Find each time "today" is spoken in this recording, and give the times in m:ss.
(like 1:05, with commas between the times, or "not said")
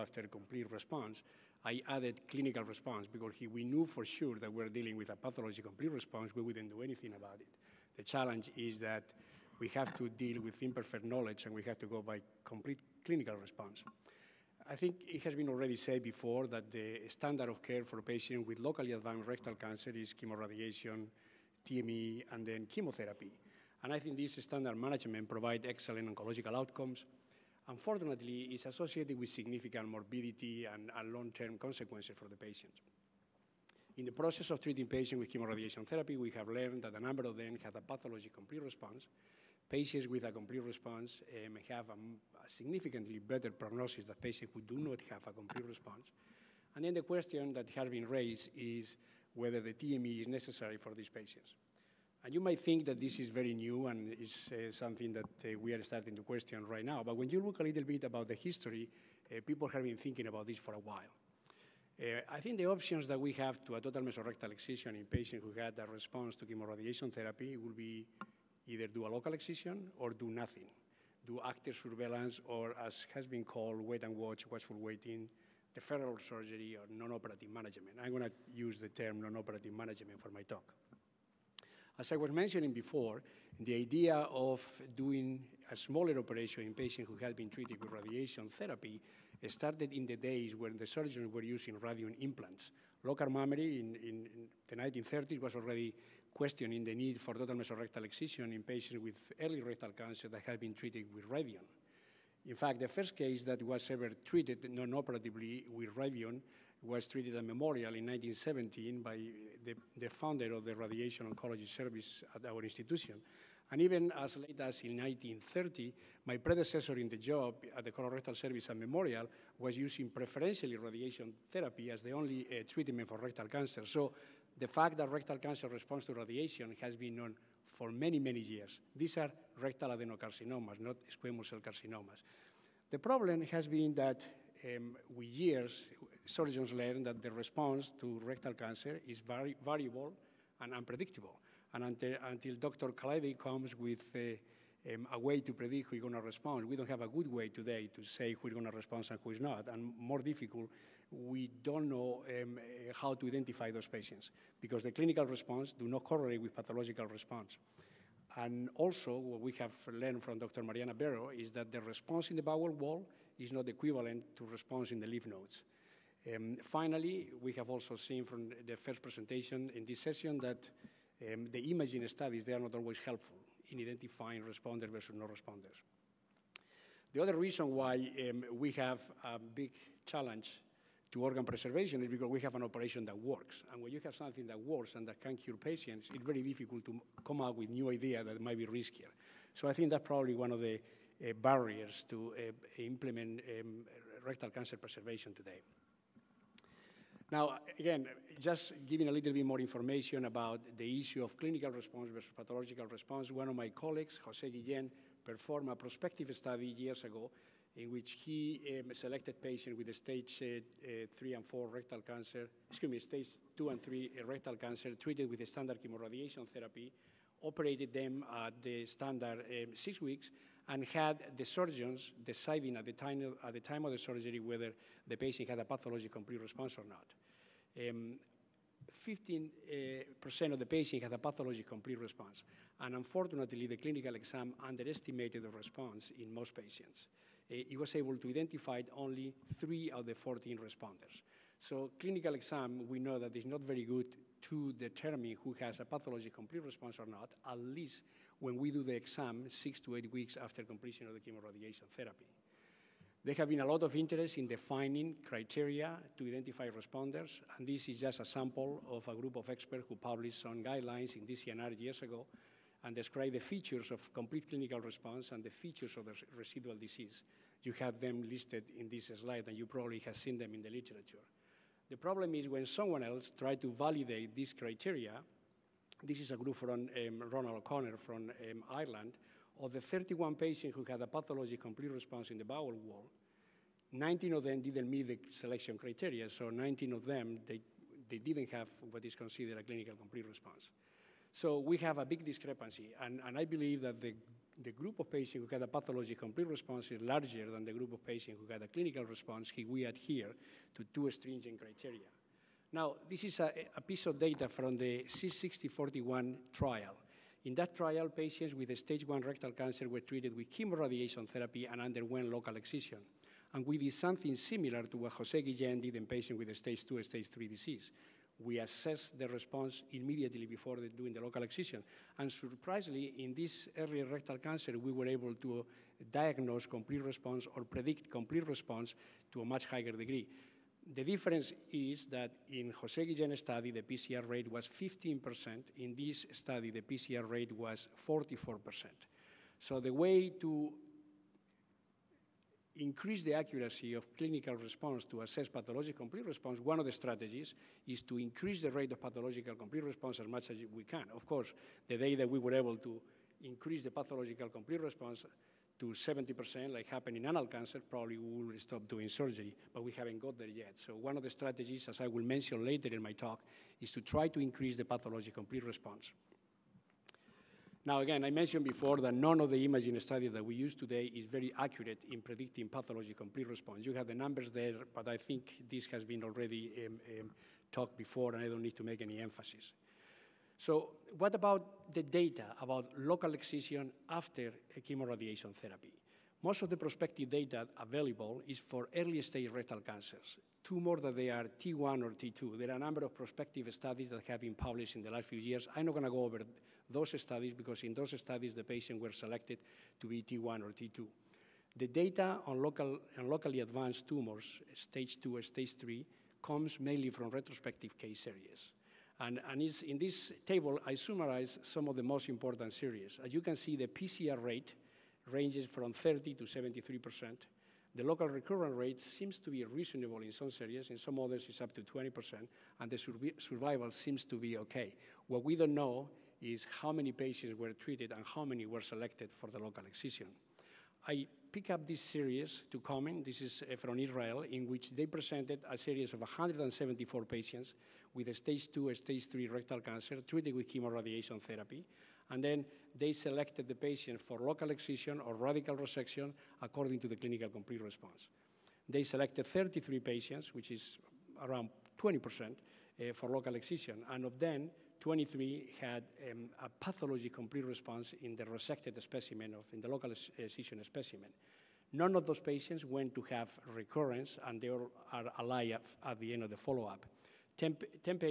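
2:27, 3:15, 6:10.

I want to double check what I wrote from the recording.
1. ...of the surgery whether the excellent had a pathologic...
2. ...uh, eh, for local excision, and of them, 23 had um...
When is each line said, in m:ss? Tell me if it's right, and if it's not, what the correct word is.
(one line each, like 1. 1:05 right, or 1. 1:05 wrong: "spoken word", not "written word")
1. 3:43 wrong: "patient", not "excellent"
2. 7:32 right.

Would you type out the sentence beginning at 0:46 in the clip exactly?
And then the question that has been raised is whether the TME is necessary for these patients.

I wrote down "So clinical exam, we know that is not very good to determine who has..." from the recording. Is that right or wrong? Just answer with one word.
right.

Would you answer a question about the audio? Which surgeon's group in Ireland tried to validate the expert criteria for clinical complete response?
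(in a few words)
Ronan O'Connell.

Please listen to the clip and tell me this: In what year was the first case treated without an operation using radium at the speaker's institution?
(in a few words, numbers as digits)
1917.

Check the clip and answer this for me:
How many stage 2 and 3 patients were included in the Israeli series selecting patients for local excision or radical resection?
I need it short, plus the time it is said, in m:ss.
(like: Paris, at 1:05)
174, at 7:16.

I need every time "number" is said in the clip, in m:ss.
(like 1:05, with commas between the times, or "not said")
0:37, 6:14, 6:32.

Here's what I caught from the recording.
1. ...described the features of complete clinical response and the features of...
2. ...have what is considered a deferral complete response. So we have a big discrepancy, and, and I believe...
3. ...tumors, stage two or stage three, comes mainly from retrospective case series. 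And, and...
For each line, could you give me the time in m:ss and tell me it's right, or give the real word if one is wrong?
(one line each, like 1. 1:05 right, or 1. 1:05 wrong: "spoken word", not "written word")
1. 4:22 right
2. 4:48 wrong: "clinical", not "deferral"
3. 6:44 right.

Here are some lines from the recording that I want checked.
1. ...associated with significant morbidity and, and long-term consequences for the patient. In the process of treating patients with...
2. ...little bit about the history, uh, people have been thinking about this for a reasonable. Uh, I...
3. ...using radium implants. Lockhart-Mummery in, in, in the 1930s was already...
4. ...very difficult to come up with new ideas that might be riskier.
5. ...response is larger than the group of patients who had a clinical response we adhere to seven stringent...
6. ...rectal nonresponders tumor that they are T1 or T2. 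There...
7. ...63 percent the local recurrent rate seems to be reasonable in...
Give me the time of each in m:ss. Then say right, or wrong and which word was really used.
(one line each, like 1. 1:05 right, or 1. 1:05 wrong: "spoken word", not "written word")
1. 0:28 right
2. 0:57 wrong: "while", not "reasonable"
3. 1:31 right
4. 3:06 right
5. 4:56 wrong: "two", not "seven"
6. 6:29 wrong: "cancers", not "nonresponders"
7. 6:56 wrong: "73", not "63".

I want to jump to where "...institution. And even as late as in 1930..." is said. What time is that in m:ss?
1:52.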